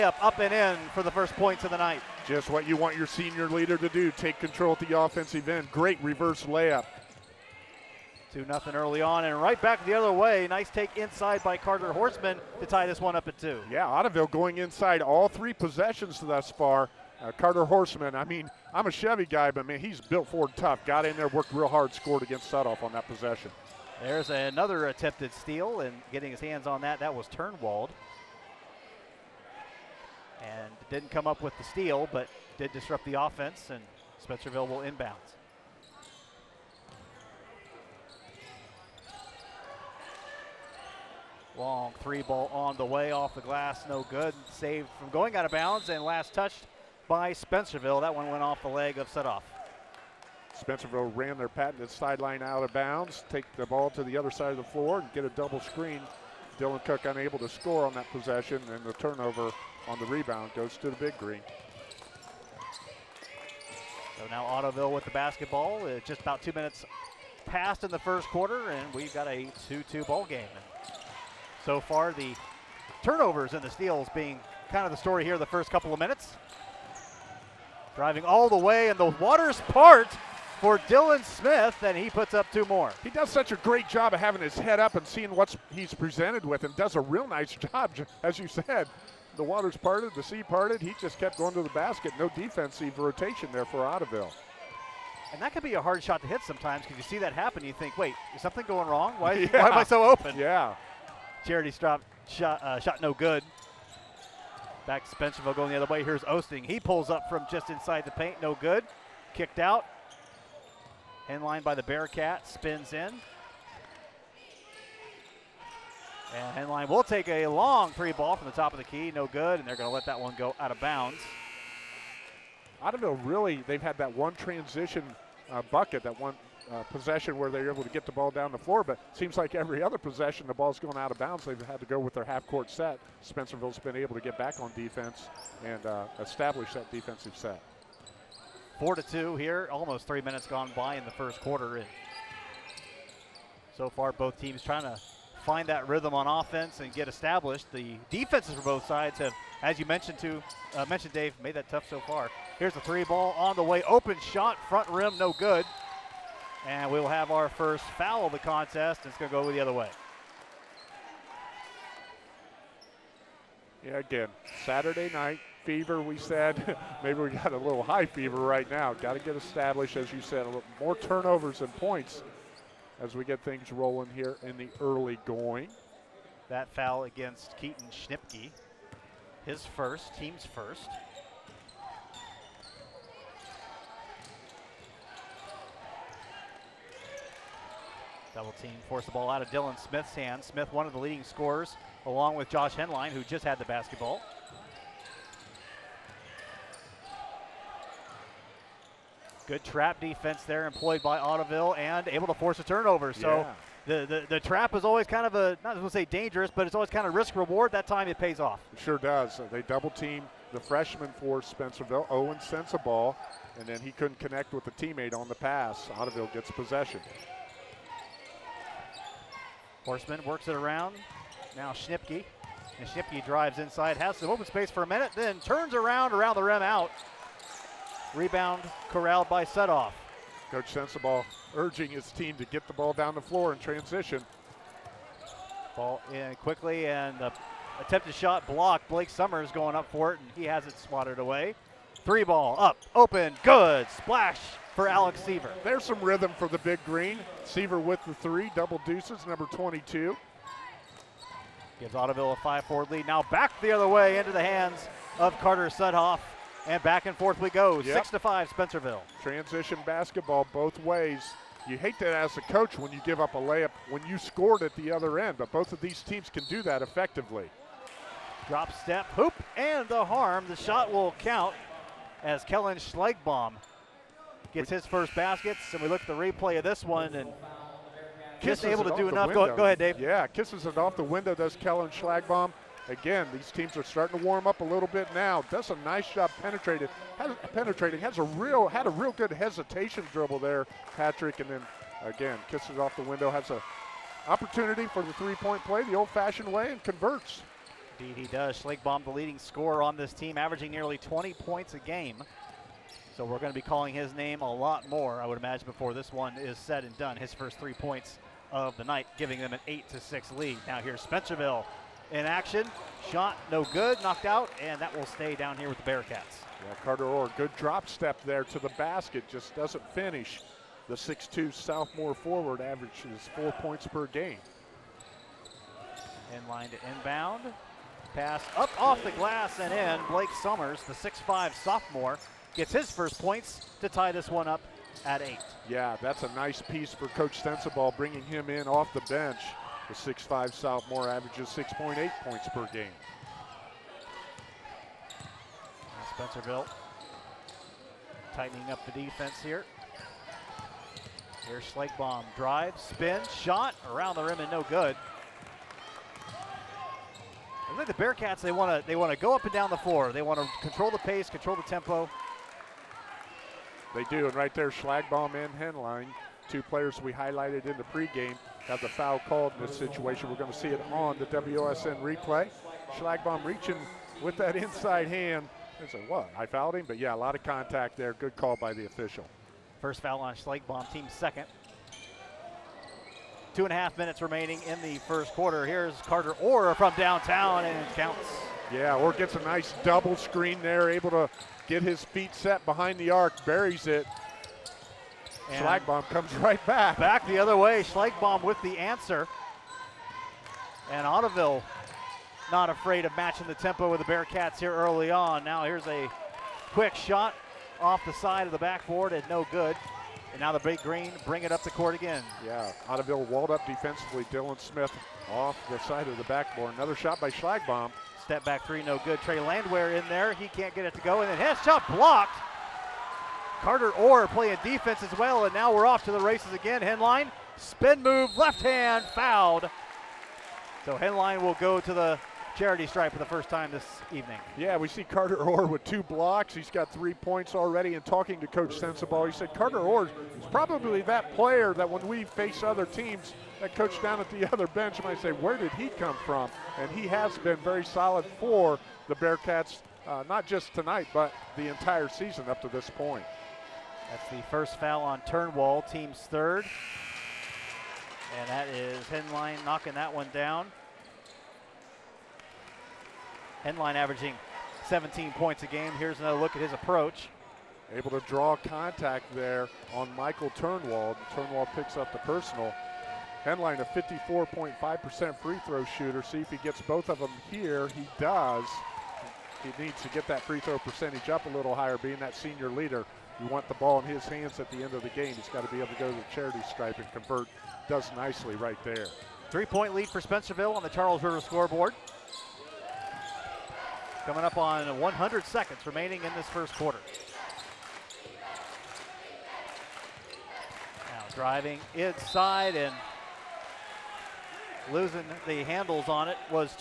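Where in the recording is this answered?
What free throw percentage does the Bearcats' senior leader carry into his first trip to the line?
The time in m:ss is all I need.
7:53.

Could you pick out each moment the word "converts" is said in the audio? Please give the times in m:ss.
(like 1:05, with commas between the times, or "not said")
4:56, 8:07.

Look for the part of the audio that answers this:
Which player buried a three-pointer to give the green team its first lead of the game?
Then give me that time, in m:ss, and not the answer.
4:04.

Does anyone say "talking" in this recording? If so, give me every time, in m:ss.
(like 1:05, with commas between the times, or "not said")
7:18.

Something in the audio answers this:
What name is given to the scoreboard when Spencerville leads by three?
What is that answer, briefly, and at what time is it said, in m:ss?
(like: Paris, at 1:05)
Charles River, at 8:10.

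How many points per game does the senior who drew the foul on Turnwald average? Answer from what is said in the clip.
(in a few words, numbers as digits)
17.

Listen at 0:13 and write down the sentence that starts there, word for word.
Yeah, Ottoville going inside all three possessions thus far.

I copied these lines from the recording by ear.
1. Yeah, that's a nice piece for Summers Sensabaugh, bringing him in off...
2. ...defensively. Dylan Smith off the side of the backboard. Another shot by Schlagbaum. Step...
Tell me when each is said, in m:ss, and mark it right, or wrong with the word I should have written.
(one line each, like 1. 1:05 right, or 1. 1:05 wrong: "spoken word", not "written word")
1. 5:35 wrong: "Coach", not "Summers"
2. 6:53 right.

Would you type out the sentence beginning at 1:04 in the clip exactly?
So now Ottoville with the basketball.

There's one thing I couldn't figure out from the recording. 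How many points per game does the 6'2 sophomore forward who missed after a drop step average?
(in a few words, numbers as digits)
4.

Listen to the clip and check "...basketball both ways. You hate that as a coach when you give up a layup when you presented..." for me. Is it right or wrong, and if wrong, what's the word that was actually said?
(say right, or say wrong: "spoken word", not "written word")
wrong: "scored", not "presented".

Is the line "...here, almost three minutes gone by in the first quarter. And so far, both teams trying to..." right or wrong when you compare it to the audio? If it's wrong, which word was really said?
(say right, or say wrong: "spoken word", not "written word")
right.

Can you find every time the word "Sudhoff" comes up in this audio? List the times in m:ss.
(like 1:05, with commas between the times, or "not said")
0:22, 0:49, 3:49, 4:15.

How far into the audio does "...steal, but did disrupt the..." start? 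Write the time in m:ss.
0:31.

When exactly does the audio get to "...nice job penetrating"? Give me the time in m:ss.
4:45.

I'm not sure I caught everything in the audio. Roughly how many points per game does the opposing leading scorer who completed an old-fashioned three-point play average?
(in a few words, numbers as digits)
nearly 20.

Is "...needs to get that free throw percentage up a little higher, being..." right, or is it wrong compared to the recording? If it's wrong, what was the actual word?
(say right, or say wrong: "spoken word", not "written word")
right.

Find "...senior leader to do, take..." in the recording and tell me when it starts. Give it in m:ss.
0:03.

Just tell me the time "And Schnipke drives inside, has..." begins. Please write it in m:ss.
3:42.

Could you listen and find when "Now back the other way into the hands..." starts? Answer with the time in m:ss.
4:13.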